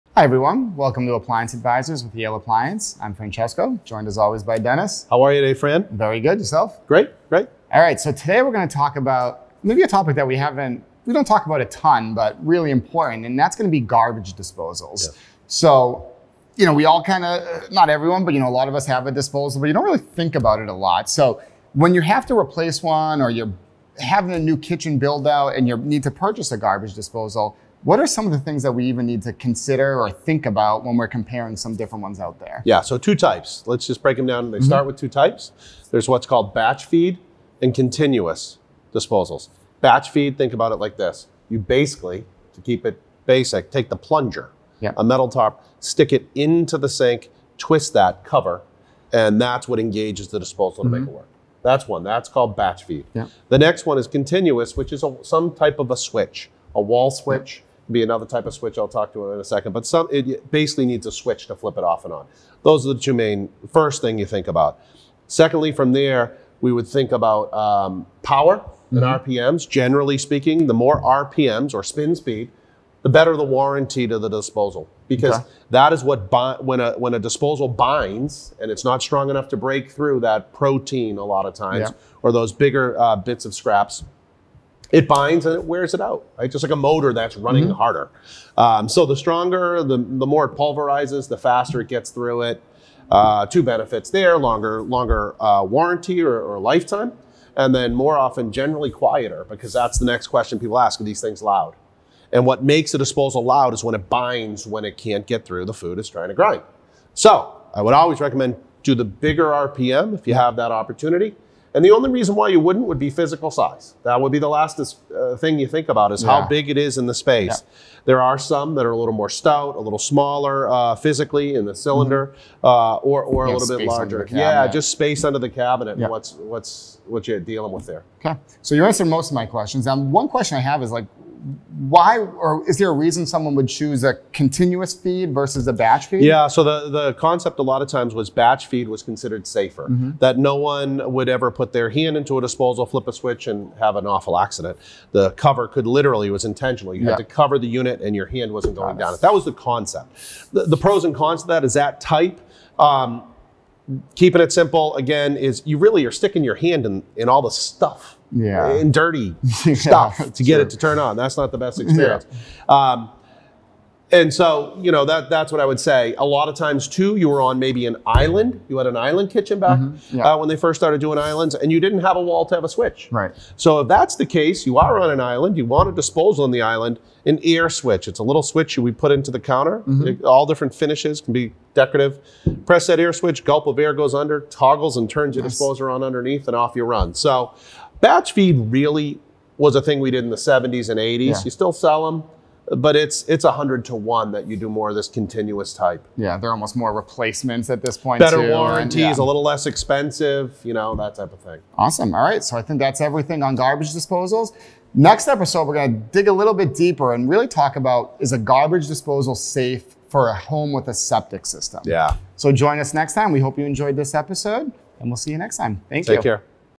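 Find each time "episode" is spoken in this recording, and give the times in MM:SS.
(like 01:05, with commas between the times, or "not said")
03:25, 03:34.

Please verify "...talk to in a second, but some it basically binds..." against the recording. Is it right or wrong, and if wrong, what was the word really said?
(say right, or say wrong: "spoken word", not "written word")
wrong: "needs", not "binds".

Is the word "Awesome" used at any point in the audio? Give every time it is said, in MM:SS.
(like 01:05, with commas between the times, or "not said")
03:21.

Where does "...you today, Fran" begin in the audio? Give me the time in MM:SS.
00:05.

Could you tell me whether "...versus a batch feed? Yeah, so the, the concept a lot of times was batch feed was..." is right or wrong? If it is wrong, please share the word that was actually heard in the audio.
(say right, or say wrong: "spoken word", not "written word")
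right.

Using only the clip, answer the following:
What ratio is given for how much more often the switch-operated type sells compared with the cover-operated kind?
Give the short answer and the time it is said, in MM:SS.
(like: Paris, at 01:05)
100 to 1, at 03:13.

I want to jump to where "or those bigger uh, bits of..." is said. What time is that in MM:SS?
01:22.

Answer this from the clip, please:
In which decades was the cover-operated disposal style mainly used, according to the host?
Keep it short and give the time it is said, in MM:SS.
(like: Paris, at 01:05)
70s and 80s, at 03:10.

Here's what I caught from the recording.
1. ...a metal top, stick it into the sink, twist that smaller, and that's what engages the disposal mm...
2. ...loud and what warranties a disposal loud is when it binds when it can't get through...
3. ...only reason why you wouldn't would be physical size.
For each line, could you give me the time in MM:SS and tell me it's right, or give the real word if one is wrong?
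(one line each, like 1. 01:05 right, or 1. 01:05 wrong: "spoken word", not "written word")
1. 00:44 wrong: "cover", not "smaller"
2. 01:41 wrong: "makes", not "warranties"
3. 01:51 right.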